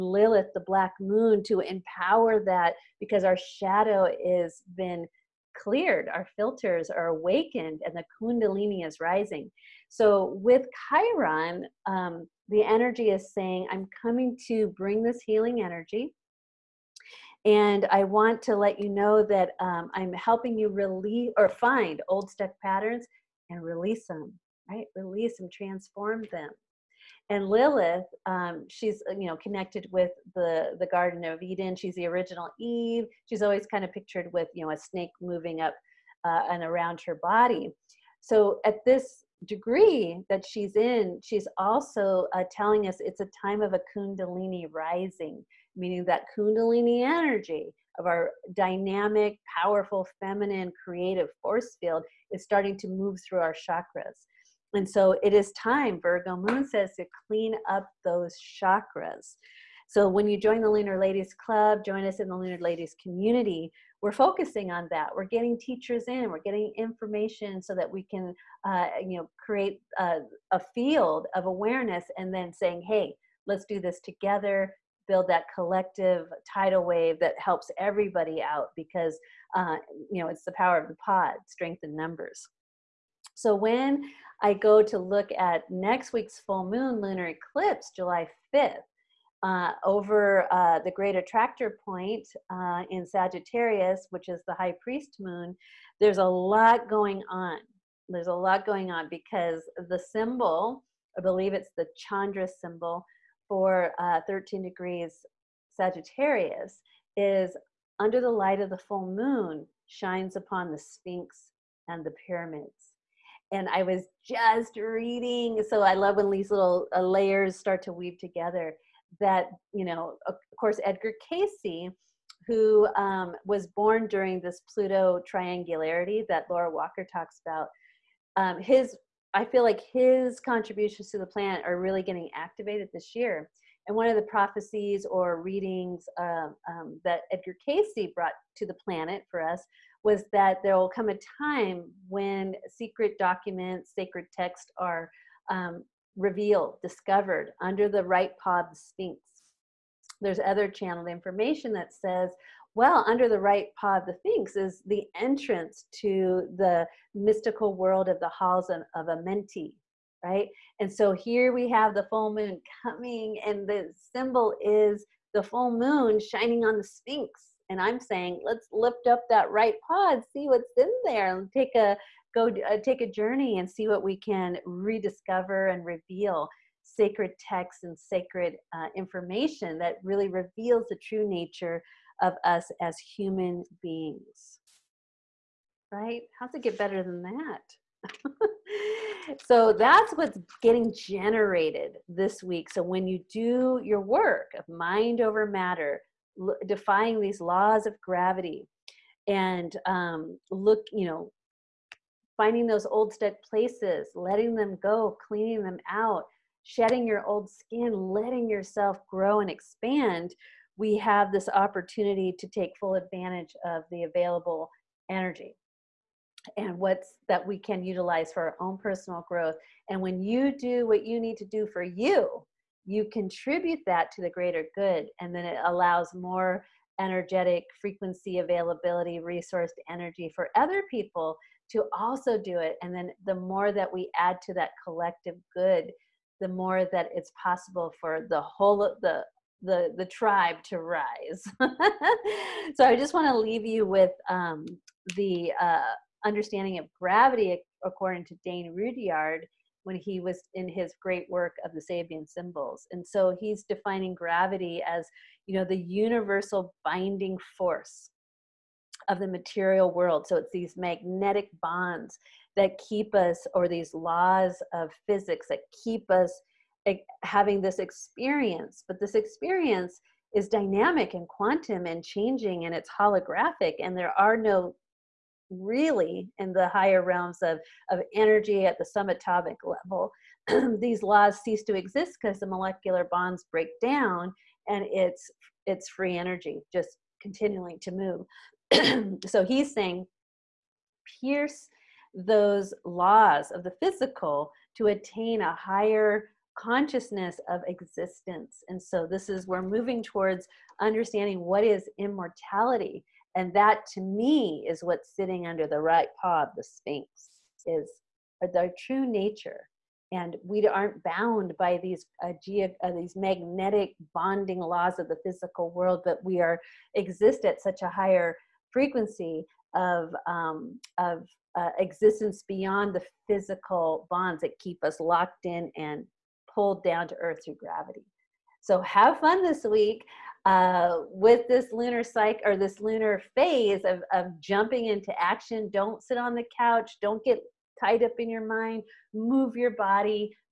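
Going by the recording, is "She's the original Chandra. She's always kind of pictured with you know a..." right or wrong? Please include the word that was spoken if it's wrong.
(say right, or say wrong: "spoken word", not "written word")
wrong: "Eve", not "Chandra".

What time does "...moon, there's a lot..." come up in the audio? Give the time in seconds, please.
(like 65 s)
95 s.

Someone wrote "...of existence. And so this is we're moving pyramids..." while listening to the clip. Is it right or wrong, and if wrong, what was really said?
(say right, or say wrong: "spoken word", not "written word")
wrong: "towards", not "pyramids".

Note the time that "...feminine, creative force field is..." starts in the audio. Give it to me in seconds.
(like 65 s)
50 s.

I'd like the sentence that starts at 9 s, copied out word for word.
So with Chiron, um, the energy is saying, I'm coming to bring this healing energy.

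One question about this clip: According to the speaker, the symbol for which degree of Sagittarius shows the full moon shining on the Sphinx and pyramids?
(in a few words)
13 degrees.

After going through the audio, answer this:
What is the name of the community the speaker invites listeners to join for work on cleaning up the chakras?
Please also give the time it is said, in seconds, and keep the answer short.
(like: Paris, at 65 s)
Lunar Ladies Club, at 60 s.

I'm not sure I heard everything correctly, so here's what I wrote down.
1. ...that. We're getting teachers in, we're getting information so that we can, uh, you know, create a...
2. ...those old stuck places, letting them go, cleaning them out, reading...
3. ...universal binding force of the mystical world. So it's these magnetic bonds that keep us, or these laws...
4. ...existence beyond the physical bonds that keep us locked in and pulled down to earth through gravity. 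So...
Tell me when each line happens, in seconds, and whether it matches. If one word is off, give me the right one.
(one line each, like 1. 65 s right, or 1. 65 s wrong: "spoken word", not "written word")
1. 64 s right
2. 202 s wrong: "shedding", not "reading"
3. 255 s wrong: "material", not "mystical"
4. 321 s right.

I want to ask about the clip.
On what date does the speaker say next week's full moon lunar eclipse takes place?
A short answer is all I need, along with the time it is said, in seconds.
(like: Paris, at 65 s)
July 5th, at 87 s.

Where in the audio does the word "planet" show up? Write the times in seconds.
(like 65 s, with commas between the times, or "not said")
131 s, 138 s.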